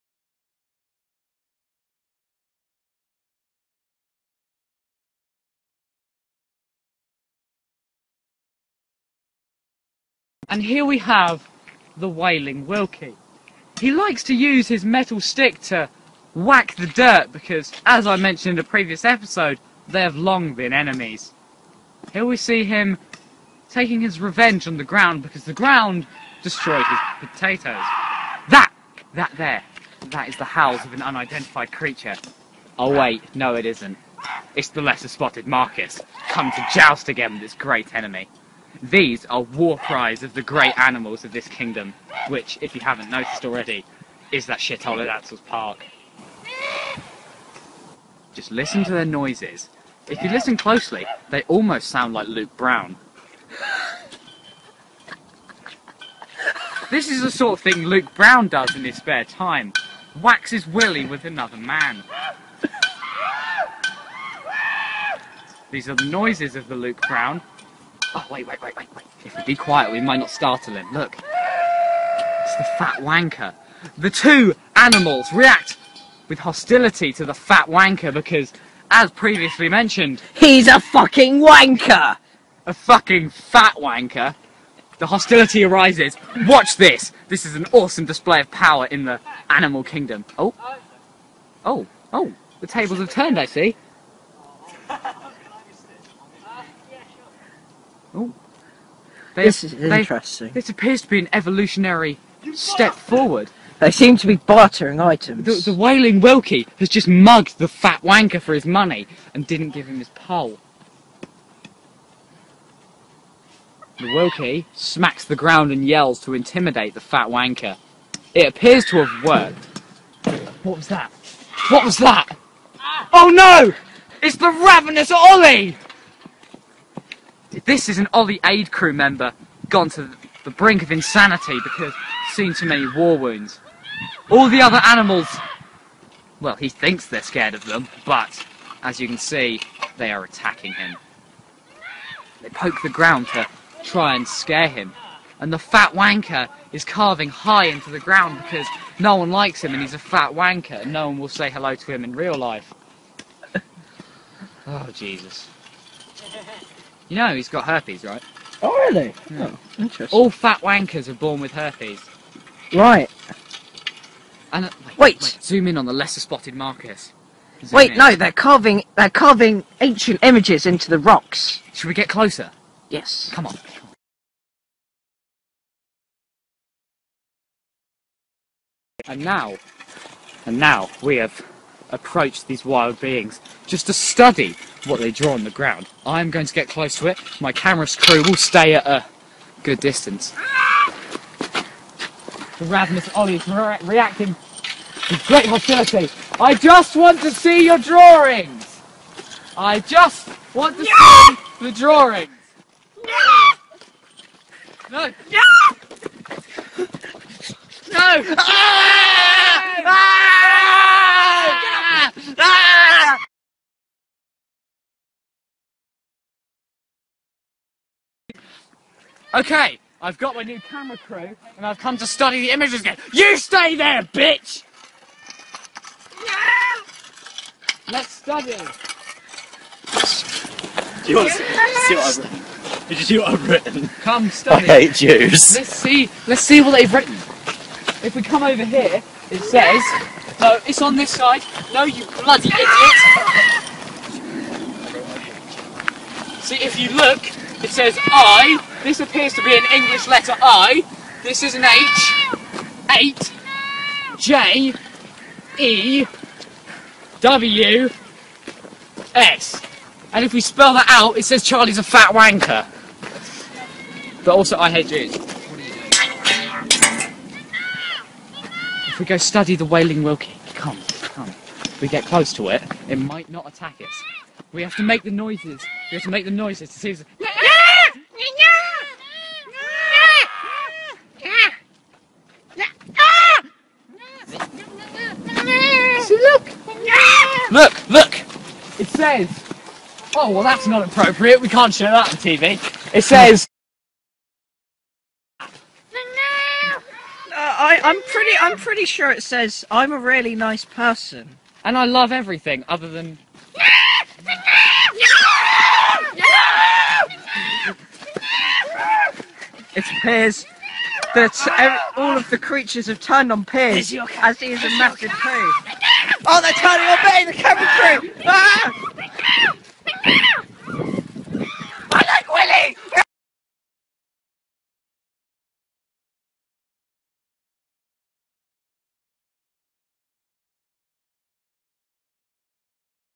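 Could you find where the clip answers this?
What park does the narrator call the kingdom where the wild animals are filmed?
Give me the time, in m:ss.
0:45.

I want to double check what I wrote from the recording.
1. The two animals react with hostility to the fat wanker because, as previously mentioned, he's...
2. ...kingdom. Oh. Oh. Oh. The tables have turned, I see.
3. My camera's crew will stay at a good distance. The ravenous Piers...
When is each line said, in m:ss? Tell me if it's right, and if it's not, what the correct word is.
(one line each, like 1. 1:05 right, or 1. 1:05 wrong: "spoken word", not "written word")
1. 1:13 right
2. 1:29 right
3. 3:07 wrong: "Ollie", not "Piers".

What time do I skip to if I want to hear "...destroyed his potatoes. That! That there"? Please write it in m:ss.
0:26.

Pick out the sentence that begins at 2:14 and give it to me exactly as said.
All the other animals, well, he thinks they're scared of them, but as you can see, they are attacking him.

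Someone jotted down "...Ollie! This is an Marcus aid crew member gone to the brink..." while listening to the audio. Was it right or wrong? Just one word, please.
wrong.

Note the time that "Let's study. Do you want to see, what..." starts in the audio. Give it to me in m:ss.
3:47.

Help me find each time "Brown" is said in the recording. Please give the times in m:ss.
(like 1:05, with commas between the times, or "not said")
0:52, 0:58, 1:07.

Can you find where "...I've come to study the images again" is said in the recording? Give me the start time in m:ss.
3:41.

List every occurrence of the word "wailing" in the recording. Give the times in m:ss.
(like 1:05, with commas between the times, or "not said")
0:12, 1:45, 4:29.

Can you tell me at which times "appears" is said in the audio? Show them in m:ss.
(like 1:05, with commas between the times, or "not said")
1:40, 1:58, 4:08, 5:09.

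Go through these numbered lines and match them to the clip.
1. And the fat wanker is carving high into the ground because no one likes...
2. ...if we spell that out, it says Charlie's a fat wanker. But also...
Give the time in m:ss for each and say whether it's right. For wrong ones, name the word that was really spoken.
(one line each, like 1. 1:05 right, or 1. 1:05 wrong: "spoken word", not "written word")
1. 2:25 right
2. 4:20 right.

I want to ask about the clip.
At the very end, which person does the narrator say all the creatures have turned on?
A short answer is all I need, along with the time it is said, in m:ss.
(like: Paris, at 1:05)
Piers, at 5:13.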